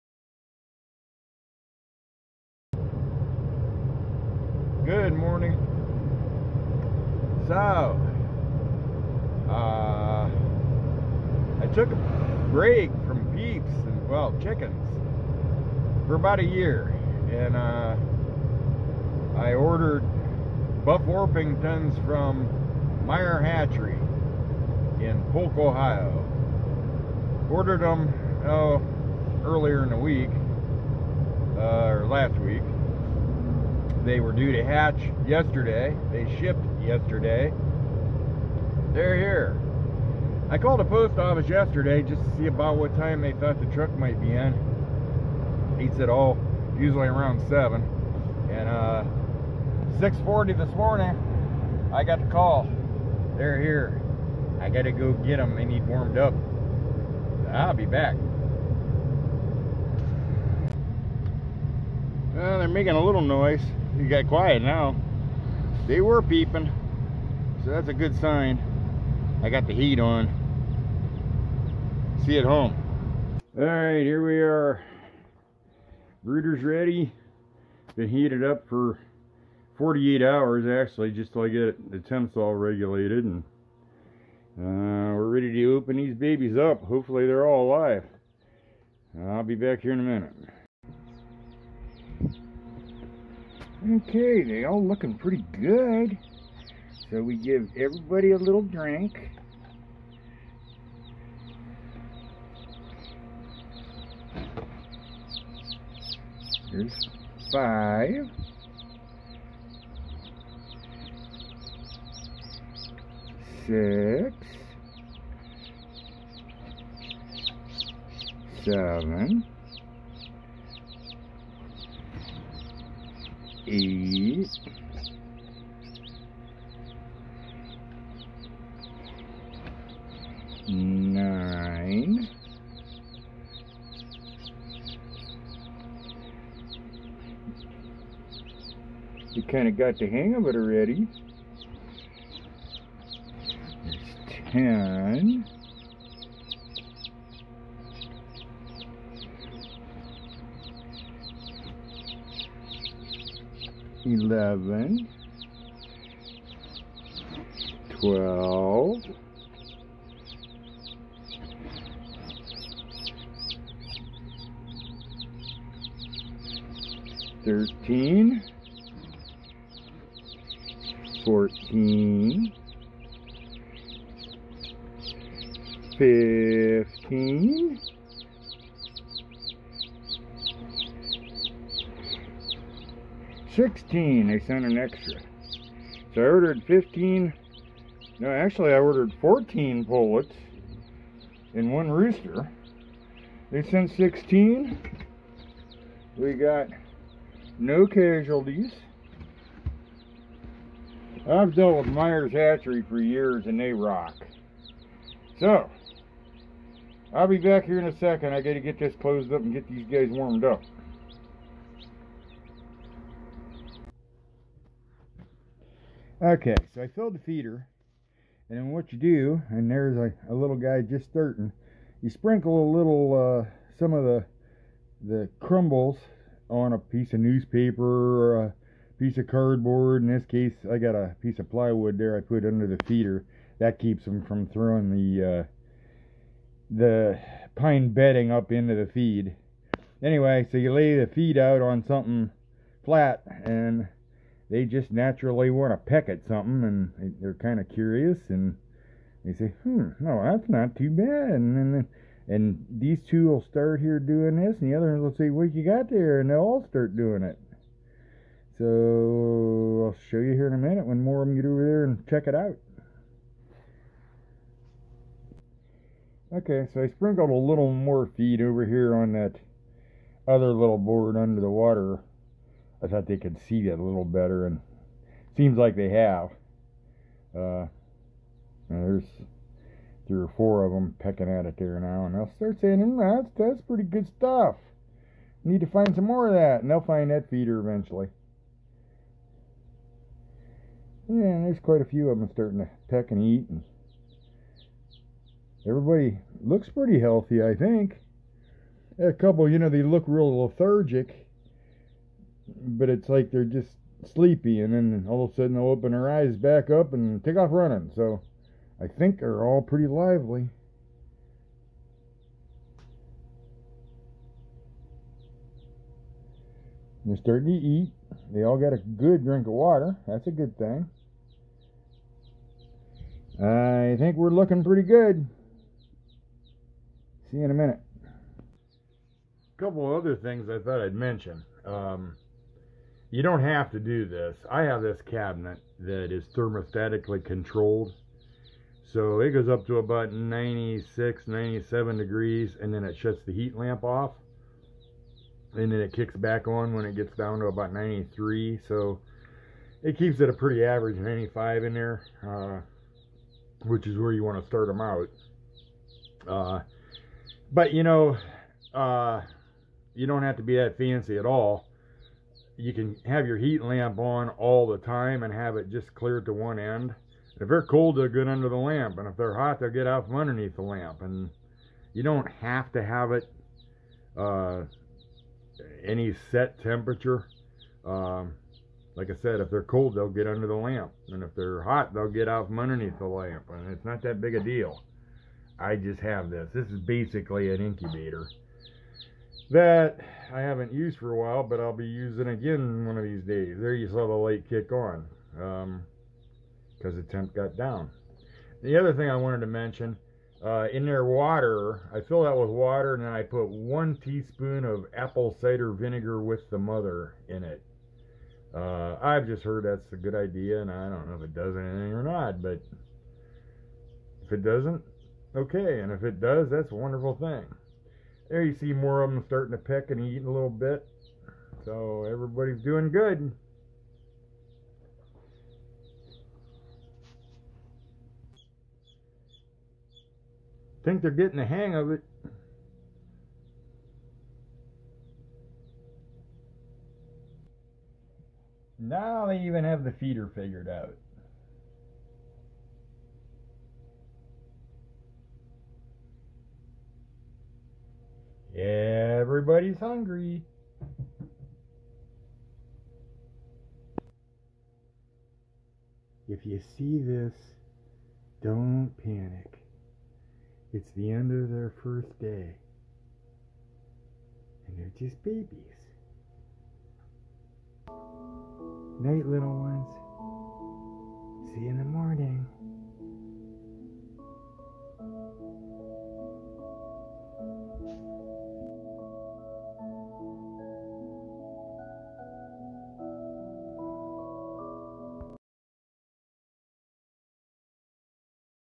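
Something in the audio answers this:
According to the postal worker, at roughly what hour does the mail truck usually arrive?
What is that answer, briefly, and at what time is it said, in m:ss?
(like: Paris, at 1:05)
7, at 0:47.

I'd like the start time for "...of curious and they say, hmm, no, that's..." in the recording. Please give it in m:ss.
4:07.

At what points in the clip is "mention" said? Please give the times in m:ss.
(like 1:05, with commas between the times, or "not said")
5:30, 6:39.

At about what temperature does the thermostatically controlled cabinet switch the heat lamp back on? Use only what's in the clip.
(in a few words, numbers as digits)
93.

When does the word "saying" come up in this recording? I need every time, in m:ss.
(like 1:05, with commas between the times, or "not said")
4:42.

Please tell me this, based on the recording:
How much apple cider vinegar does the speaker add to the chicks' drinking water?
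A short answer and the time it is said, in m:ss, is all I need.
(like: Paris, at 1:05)
1 teaspoon, at 6:43.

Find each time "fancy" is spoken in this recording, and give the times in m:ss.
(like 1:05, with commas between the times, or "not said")
6:00.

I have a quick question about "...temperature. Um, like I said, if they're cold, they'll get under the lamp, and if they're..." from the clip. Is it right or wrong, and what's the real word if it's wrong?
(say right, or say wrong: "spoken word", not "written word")
right.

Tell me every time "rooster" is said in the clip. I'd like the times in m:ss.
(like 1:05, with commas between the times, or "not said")
3:11.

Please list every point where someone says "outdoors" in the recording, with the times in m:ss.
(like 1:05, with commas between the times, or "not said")
not said.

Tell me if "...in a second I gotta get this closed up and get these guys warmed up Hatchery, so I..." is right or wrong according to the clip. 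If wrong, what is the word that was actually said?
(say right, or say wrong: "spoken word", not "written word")
wrong: "Okay", not "Hatchery".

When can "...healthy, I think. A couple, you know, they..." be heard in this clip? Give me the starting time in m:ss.
4:56.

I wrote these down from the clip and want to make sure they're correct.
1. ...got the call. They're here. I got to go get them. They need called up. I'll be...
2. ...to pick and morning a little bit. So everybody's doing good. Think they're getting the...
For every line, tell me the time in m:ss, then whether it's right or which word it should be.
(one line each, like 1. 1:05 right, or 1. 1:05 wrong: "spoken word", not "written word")
1. 0:52 wrong: "warmed", not "called"
2. 6:59 wrong: "eating", not "morning".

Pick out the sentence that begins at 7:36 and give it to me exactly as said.
If you see this, don't panic.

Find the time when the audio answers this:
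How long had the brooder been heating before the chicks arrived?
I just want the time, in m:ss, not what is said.
1:19.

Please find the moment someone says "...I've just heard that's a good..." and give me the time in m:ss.
6:49.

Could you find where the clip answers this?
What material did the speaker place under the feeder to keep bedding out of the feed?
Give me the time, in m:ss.
3:51.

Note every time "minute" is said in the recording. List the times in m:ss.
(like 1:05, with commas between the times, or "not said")
1:30, 4:20, 5:27.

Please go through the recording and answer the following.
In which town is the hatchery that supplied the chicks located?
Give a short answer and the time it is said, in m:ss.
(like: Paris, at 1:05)
Polk, Ohio, at 0:25.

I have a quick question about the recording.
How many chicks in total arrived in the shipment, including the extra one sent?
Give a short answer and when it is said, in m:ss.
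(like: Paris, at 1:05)
16, at 3:13.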